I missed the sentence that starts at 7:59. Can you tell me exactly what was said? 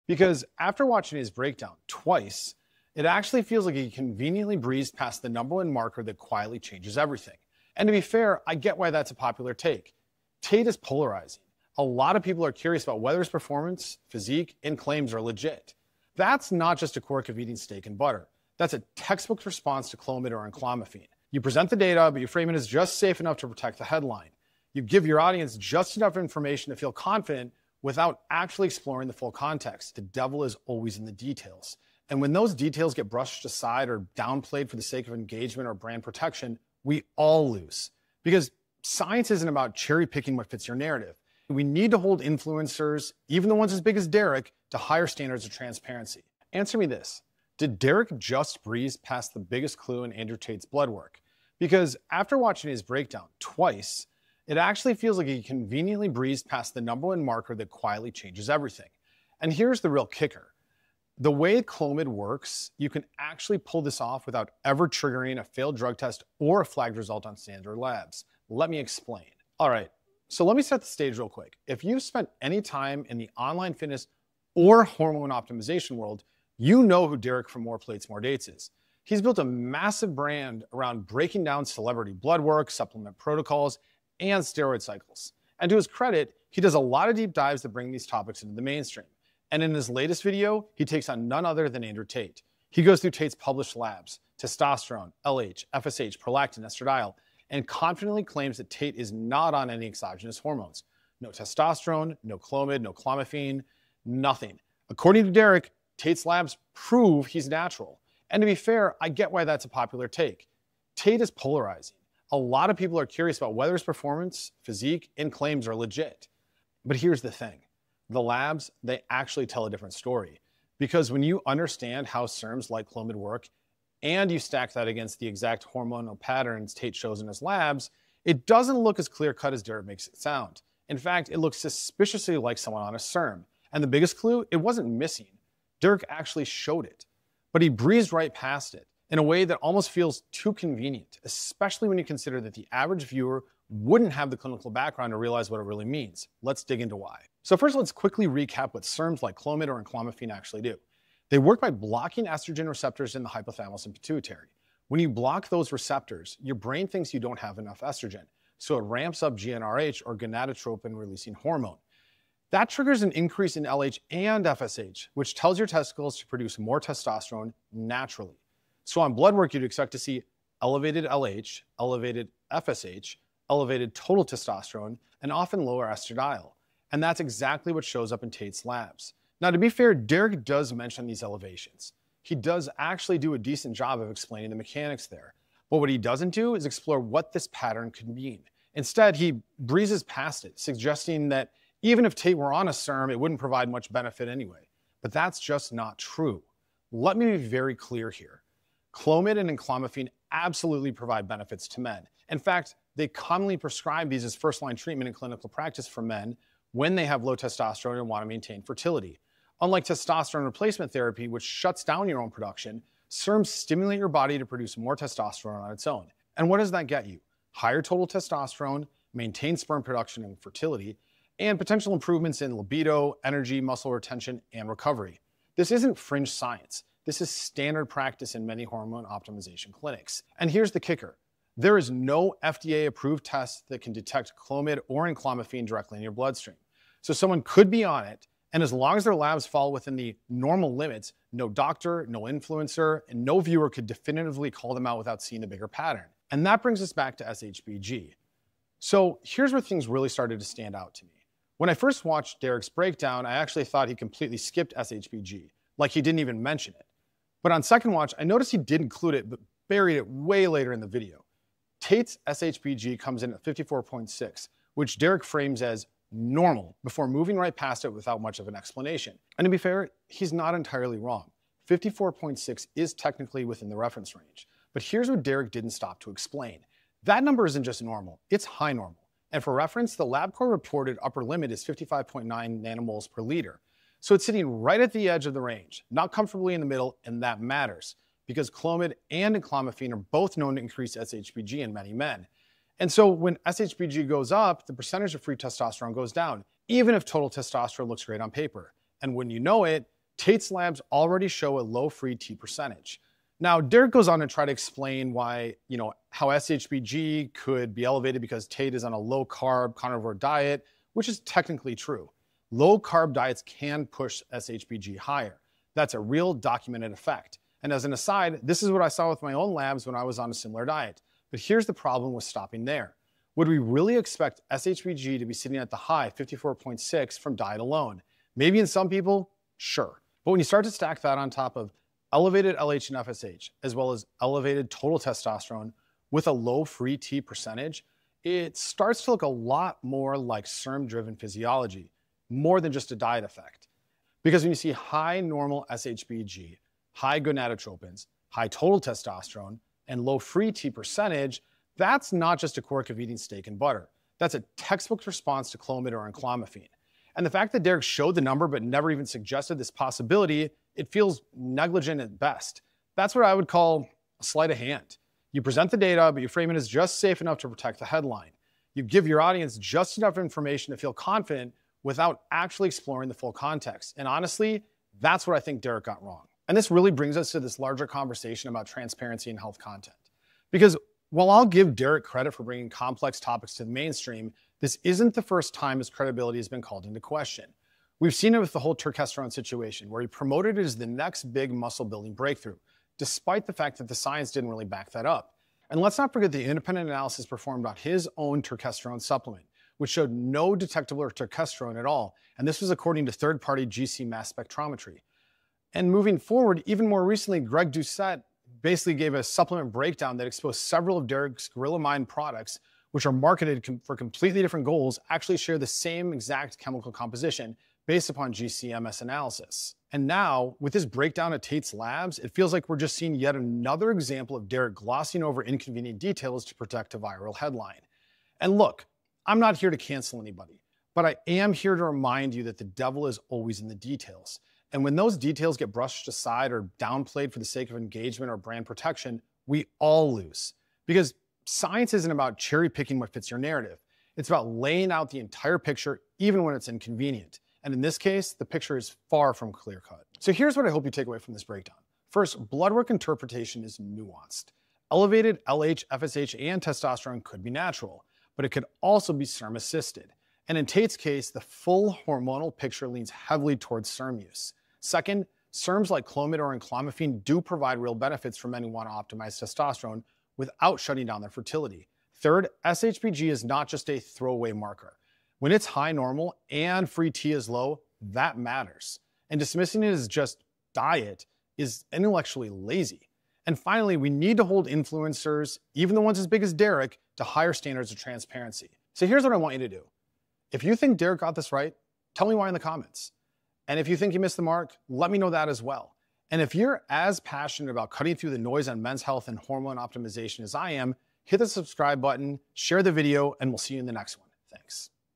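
And dismissing it as just diet is intellectually lazy.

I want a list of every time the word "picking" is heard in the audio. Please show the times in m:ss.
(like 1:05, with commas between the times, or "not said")
0:40, 7:22.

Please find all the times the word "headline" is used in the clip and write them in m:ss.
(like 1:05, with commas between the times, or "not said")
0:23, 6:07, 7:07.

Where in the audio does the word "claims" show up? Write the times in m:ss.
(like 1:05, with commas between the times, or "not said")
0:14, 1:38, 1:55.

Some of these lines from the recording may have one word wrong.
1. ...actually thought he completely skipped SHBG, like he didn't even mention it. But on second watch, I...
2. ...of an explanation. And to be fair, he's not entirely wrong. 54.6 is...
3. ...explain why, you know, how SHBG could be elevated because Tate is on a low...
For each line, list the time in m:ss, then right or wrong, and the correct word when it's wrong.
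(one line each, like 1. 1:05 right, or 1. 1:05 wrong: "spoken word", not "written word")
1. 4:13 right
2. 4:28 right
3. 5:04 right.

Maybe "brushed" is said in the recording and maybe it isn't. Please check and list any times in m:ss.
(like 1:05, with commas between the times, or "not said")
0:33, 7:15.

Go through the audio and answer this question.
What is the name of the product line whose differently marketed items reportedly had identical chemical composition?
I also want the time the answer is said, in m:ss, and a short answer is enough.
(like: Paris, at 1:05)
Gorilla Mind, at 6:51.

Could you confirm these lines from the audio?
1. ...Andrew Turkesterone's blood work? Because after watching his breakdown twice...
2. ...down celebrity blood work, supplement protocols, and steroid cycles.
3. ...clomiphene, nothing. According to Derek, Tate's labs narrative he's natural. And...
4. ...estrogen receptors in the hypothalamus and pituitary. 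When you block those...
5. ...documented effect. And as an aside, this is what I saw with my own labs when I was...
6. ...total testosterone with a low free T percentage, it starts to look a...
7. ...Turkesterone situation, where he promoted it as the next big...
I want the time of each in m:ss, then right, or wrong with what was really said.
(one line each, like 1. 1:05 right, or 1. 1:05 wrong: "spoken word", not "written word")
1. 0:50 wrong: "Tate", not "Turkesterone"
2. 1:21 right
3. 1:42 wrong: "prove", not "narrative"
4. 2:32 right
5. 5:16 right
6. 5:34 right
7. 6:28 right.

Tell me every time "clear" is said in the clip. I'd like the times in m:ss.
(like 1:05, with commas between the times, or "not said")
2:09, 3:17, 7:29.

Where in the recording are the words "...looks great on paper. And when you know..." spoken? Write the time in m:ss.
4:57.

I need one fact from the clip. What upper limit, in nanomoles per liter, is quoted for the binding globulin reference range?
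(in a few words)
55.9.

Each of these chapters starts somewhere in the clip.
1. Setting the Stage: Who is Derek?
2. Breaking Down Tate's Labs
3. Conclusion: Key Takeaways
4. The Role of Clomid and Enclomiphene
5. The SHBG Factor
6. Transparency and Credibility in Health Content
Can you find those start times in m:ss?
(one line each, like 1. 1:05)
1. 1:09
2. 1:32
3. 7:30
4. 2:27
5. 4:06
6. 6:16.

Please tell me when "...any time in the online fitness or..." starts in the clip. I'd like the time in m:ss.
1:12.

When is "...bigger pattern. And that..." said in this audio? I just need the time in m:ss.
4:05.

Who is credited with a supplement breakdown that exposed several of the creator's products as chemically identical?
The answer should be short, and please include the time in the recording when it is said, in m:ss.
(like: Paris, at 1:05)
Greg Doucette, at 6:47.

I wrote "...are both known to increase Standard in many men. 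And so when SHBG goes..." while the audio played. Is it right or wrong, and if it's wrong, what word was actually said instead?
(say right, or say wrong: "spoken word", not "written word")
wrong: "SHBG", not "Standard".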